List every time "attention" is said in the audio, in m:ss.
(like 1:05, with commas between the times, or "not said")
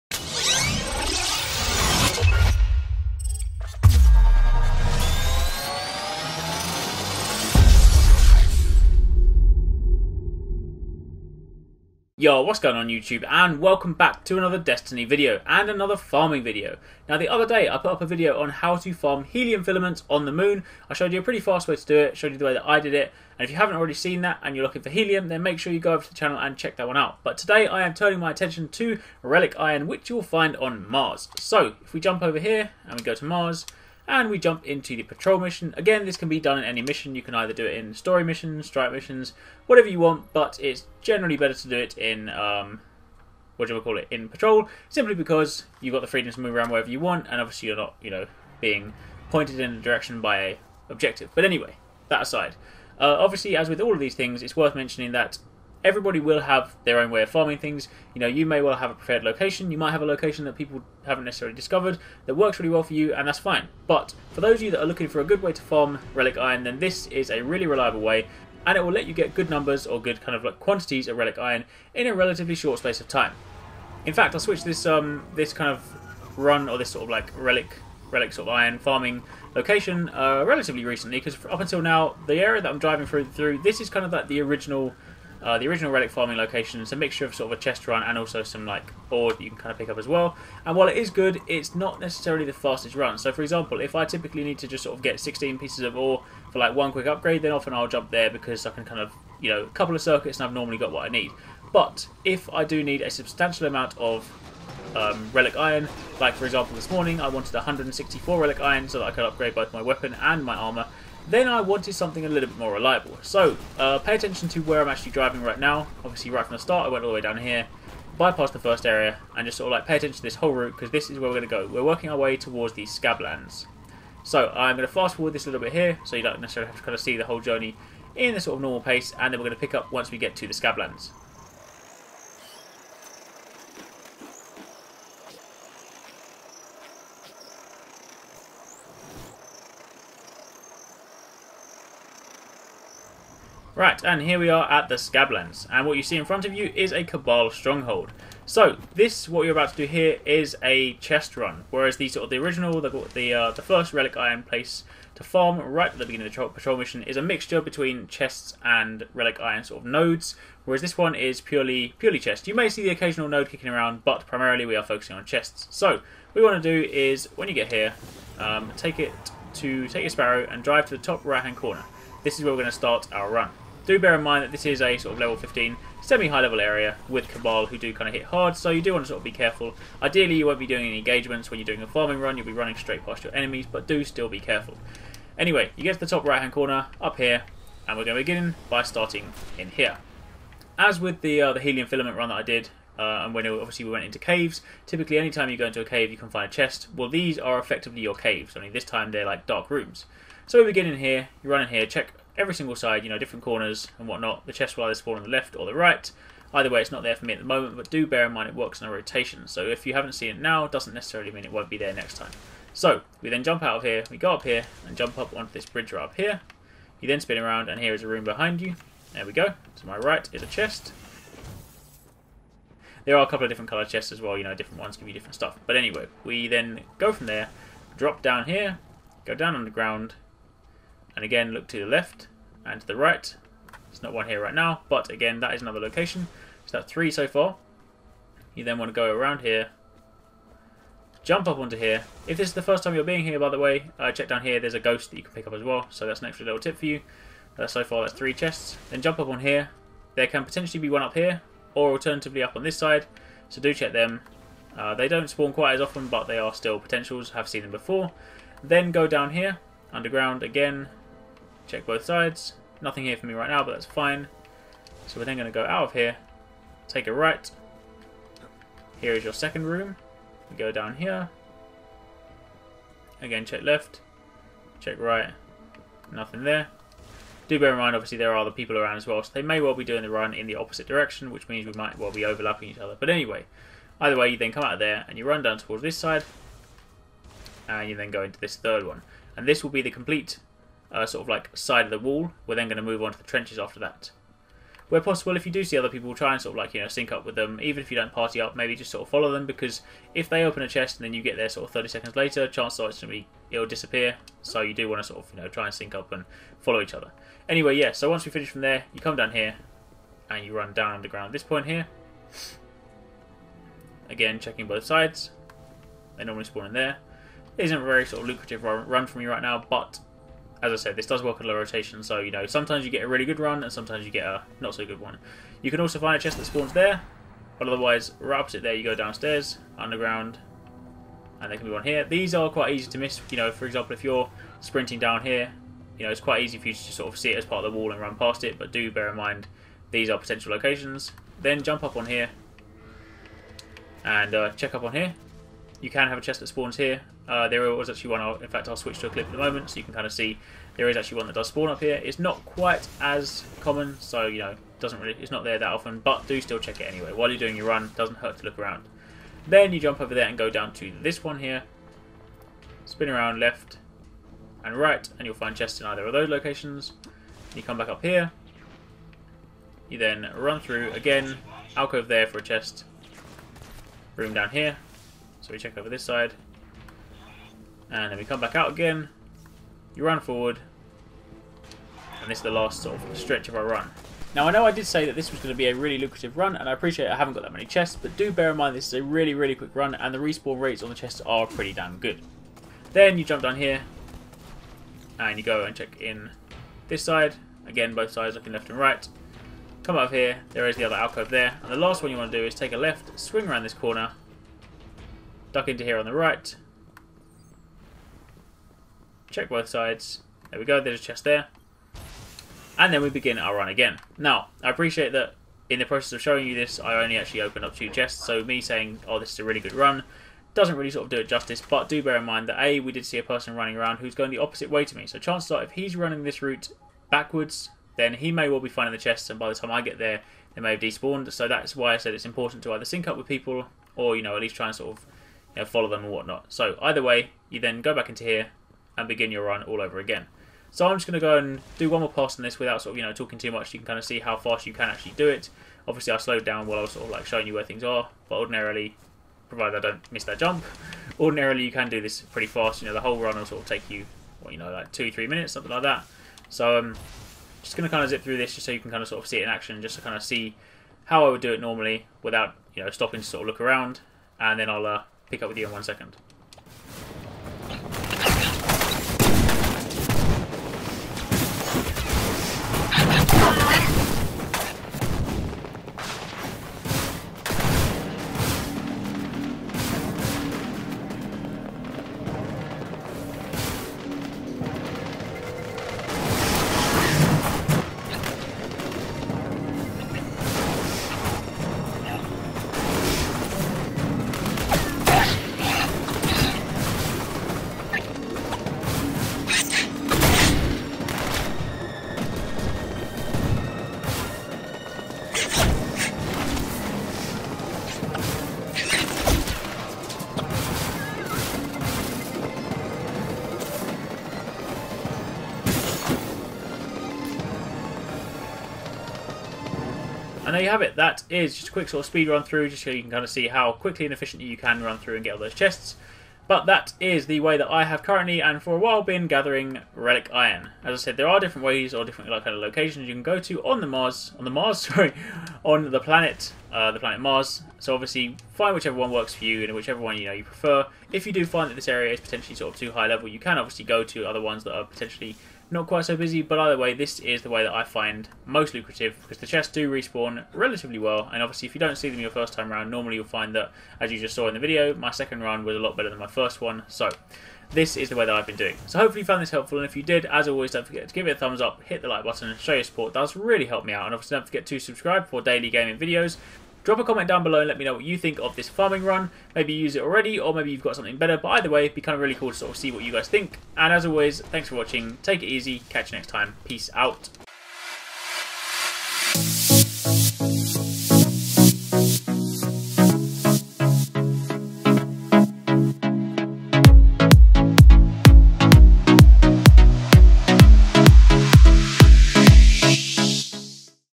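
0:28, 1:54, 1:59.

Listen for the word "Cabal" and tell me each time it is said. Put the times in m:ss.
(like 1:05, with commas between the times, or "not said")
2:27, 2:57.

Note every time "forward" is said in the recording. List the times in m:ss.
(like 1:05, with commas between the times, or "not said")
2:05, 6:20.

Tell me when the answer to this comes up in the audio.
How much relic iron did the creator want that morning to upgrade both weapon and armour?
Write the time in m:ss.
1:47.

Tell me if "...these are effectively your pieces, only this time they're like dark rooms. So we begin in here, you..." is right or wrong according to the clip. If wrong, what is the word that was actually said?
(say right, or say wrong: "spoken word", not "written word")
wrong: "caves", not "pieces".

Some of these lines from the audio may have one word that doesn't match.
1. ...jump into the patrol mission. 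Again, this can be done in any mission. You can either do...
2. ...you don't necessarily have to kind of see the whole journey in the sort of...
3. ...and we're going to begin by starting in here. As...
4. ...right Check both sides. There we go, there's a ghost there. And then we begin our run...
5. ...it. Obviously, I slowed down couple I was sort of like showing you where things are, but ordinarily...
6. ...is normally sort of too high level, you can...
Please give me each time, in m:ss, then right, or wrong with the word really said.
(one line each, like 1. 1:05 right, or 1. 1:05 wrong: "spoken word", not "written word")
1. 0:34 right
2. 2:06 right
3. 3:07 right
4. 6:46 wrong: "chest", not "ghost"
5. 7:25 wrong: "while", not "couple"
6. 9:02 wrong: "potentially", not "normally".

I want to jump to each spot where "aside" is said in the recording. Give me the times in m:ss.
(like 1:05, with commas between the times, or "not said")
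0:52.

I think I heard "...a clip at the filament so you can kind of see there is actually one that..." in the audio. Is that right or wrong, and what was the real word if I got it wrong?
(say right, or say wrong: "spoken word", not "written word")
wrong: "moment", not "filament".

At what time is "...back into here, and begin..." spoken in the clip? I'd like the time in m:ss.
7:17.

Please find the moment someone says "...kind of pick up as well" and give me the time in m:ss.
1:29.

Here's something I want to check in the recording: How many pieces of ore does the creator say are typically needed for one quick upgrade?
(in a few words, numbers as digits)
16.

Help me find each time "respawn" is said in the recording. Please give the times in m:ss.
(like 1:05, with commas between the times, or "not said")
6:30, 9:09.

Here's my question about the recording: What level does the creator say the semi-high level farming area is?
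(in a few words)
15.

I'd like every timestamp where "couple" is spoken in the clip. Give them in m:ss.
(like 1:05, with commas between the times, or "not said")
1:39, 3:43.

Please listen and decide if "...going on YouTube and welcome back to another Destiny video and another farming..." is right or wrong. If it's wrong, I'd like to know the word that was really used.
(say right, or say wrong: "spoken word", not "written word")
right.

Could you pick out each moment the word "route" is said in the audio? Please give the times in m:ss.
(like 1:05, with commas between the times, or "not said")
2:00, 7:06.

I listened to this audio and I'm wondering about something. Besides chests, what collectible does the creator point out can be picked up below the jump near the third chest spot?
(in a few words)
A ghost.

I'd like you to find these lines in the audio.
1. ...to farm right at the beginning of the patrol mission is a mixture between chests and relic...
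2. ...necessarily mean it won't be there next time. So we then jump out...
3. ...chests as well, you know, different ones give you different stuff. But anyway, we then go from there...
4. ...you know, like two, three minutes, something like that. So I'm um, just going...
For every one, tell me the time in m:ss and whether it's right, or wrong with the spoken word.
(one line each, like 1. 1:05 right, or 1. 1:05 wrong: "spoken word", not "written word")
1. 2:35 right
2. 3:30 right
3. 3:43 right
4. 7:34 right.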